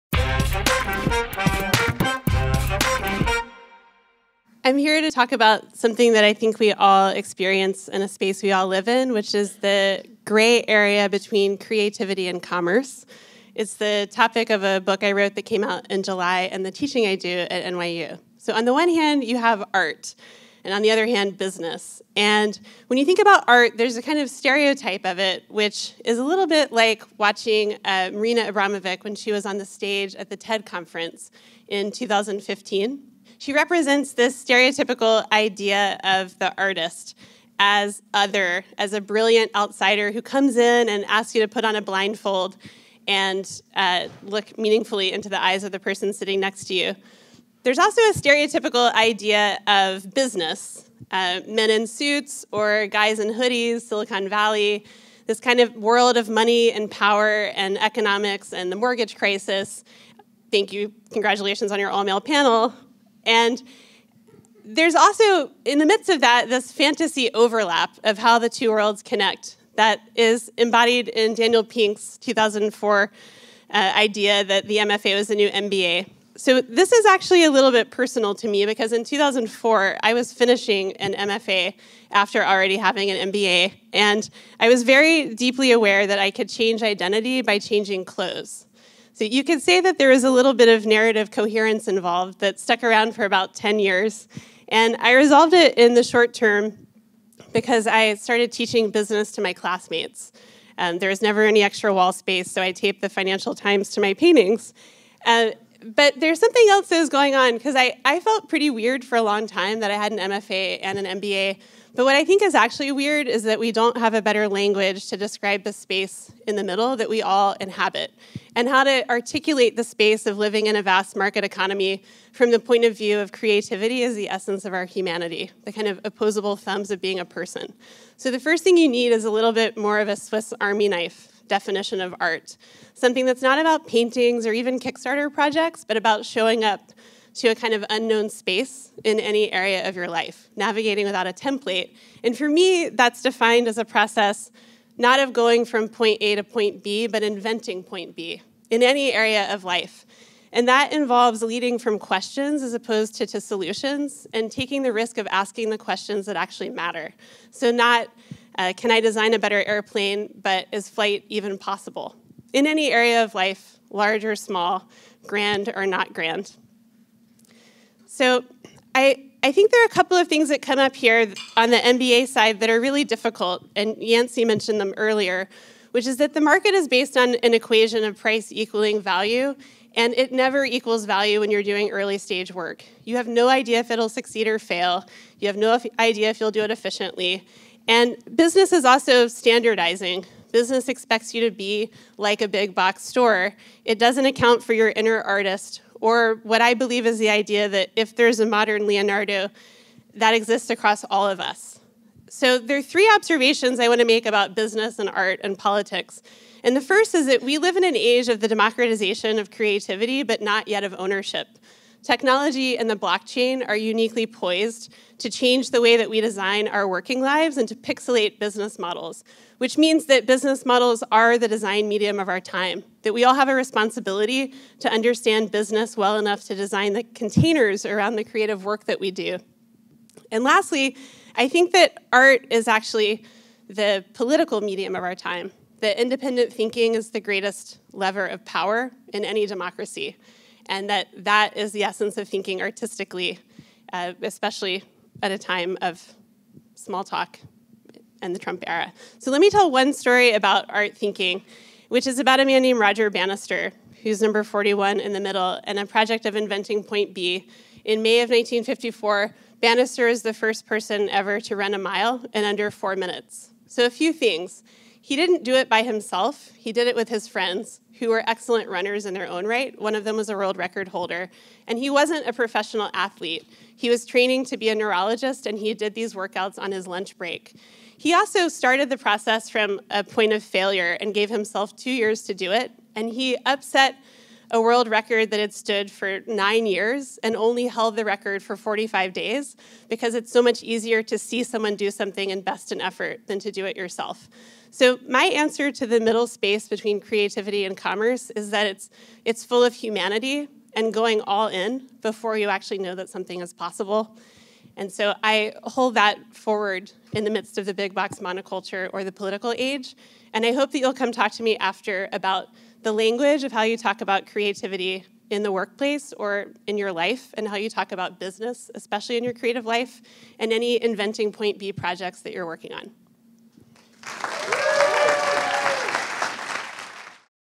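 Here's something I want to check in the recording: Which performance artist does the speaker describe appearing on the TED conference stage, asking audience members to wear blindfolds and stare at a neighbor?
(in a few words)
Marina Abramovic.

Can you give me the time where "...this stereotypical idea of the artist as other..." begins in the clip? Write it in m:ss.
0:34.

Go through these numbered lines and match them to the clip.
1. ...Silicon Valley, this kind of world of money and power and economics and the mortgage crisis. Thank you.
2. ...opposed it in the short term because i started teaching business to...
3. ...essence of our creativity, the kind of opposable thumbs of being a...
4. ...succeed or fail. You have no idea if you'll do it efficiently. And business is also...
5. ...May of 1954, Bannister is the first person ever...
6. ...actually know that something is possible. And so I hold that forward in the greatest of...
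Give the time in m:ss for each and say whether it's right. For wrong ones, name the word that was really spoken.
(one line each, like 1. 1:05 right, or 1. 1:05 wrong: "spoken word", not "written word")
1. 0:53 right
2. 1:35 wrong: "resolved", not "opposed"
3. 2:04 wrong: "humanity", not "creativity"
4. 3:04 right
5. 4:18 right
6. 5:02 wrong: "midst", not "greatest".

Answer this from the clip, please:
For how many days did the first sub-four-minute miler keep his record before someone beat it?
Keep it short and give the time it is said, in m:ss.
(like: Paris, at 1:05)
45, at 4:48.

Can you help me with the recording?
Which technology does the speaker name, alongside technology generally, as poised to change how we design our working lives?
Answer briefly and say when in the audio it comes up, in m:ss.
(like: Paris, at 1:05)
blockchain, at 3:32.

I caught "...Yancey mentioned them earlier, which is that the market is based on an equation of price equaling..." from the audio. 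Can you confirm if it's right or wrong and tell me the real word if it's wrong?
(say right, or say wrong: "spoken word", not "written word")
right.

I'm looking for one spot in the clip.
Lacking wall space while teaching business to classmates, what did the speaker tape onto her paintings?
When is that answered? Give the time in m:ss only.
1:43.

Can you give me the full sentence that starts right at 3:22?
So there are three observations I want to make about business and art and politics.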